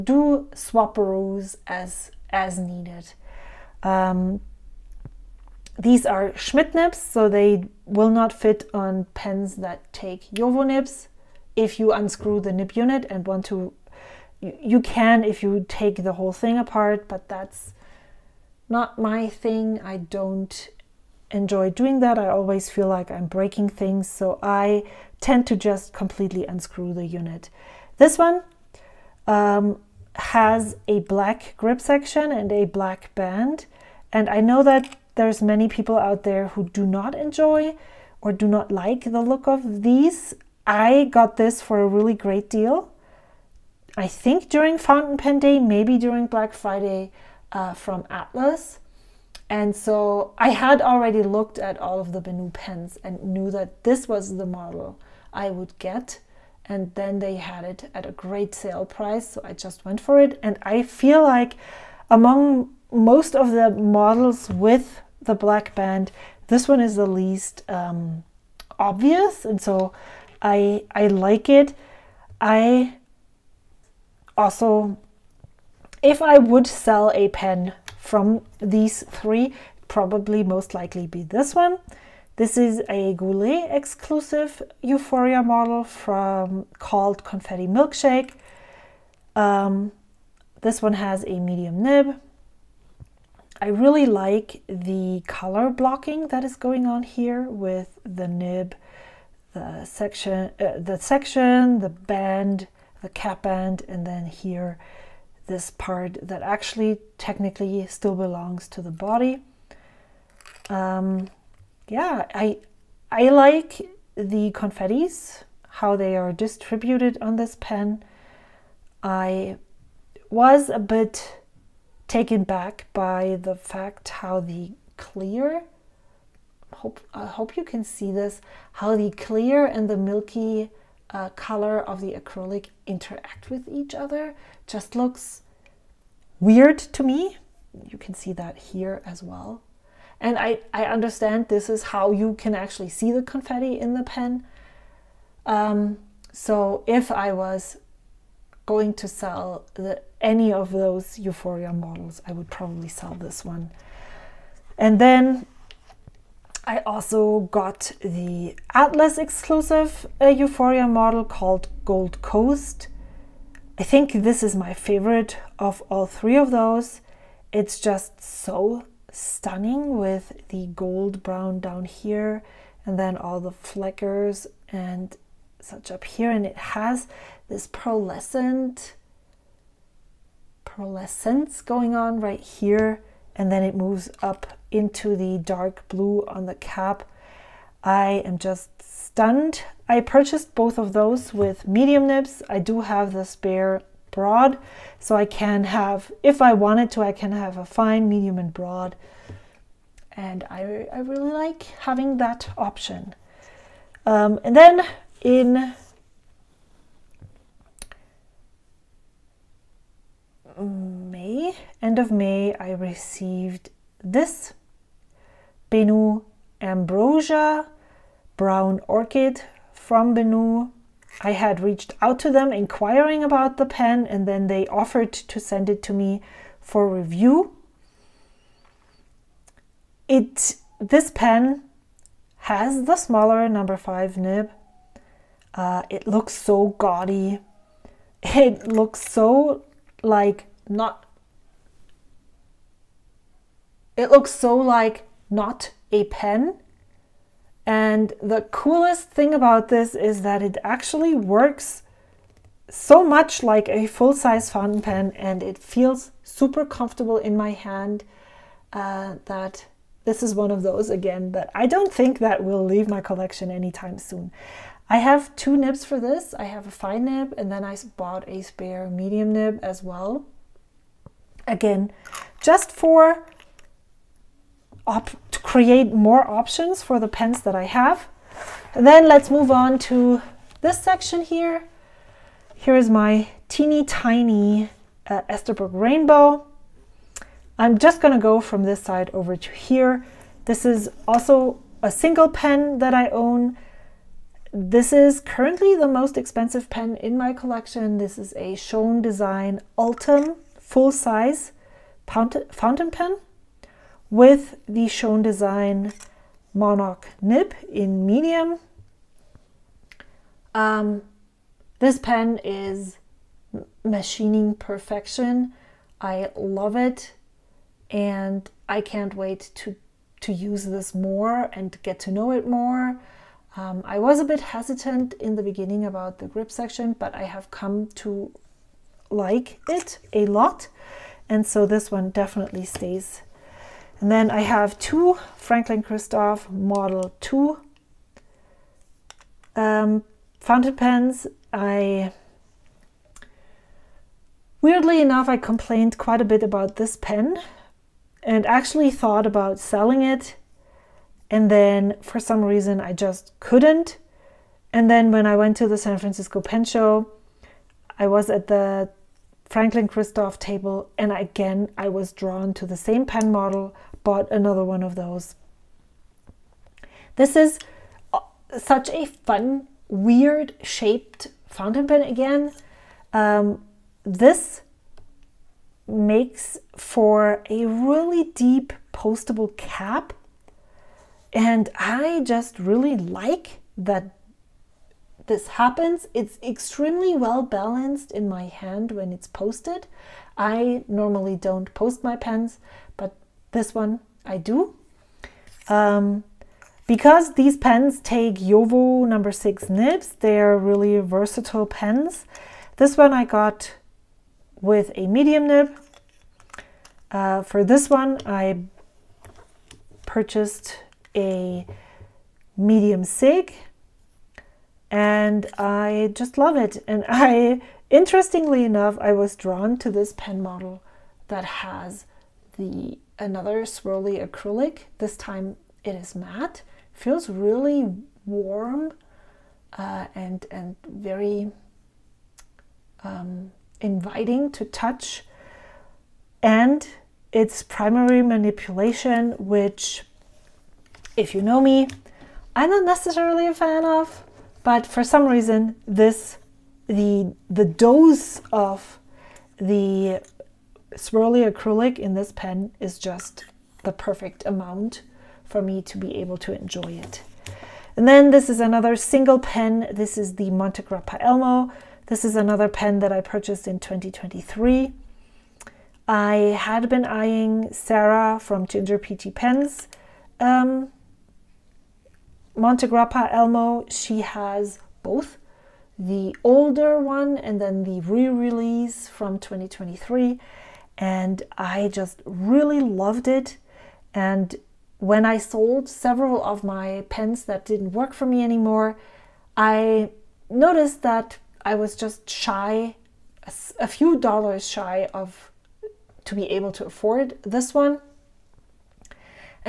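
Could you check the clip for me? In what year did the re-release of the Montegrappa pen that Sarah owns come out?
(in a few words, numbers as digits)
2023.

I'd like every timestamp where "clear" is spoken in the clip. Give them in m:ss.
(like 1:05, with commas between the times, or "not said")
2:04, 2:09.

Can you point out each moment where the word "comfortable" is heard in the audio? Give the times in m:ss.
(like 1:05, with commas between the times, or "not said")
4:16.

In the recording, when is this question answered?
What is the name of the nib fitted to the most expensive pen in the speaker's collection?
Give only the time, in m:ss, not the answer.
5:06.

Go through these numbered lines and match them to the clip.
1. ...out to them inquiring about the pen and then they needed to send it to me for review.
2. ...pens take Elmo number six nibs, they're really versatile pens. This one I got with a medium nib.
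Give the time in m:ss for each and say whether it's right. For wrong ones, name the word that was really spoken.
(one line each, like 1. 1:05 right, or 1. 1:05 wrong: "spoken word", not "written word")
1. 3:42 wrong: "offered", not "needed"
2. 6:37 wrong: "JoWo", not "Elmo".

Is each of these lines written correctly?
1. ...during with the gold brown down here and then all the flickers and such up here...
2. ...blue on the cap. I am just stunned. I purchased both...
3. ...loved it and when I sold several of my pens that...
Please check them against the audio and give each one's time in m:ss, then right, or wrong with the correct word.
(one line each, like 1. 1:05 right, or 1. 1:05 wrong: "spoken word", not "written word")
1. 2:49 wrong: "stunning", not "during"
2. 3:05 right
3. 8:02 right.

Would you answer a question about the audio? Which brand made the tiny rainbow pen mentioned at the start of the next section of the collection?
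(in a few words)
Esterbrook.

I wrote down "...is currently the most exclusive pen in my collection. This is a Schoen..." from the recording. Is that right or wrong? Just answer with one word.
wrong.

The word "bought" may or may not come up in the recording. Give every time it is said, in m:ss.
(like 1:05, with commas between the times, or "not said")
4:27, 6:04.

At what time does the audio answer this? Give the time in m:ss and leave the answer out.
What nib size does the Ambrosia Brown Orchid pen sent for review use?
3:53.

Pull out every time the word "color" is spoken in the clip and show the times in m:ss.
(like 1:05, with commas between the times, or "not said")
1:35, 2:11.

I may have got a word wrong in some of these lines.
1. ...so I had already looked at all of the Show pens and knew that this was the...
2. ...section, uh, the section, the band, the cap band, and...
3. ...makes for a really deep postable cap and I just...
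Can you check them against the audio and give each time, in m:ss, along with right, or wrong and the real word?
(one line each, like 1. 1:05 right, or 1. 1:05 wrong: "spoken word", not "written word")
1. 0:49 wrong: "Benu", not "Show"
2. 1:39 right
3. 6:15 right.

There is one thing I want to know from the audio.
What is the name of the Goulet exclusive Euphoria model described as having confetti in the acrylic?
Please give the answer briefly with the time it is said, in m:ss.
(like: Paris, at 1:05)
Confetti Milkshake, at 1:27.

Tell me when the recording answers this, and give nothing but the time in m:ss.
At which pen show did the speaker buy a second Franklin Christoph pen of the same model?
5:55.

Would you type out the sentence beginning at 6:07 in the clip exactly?
This is uh, such a fun, weird shaped fountain pen again.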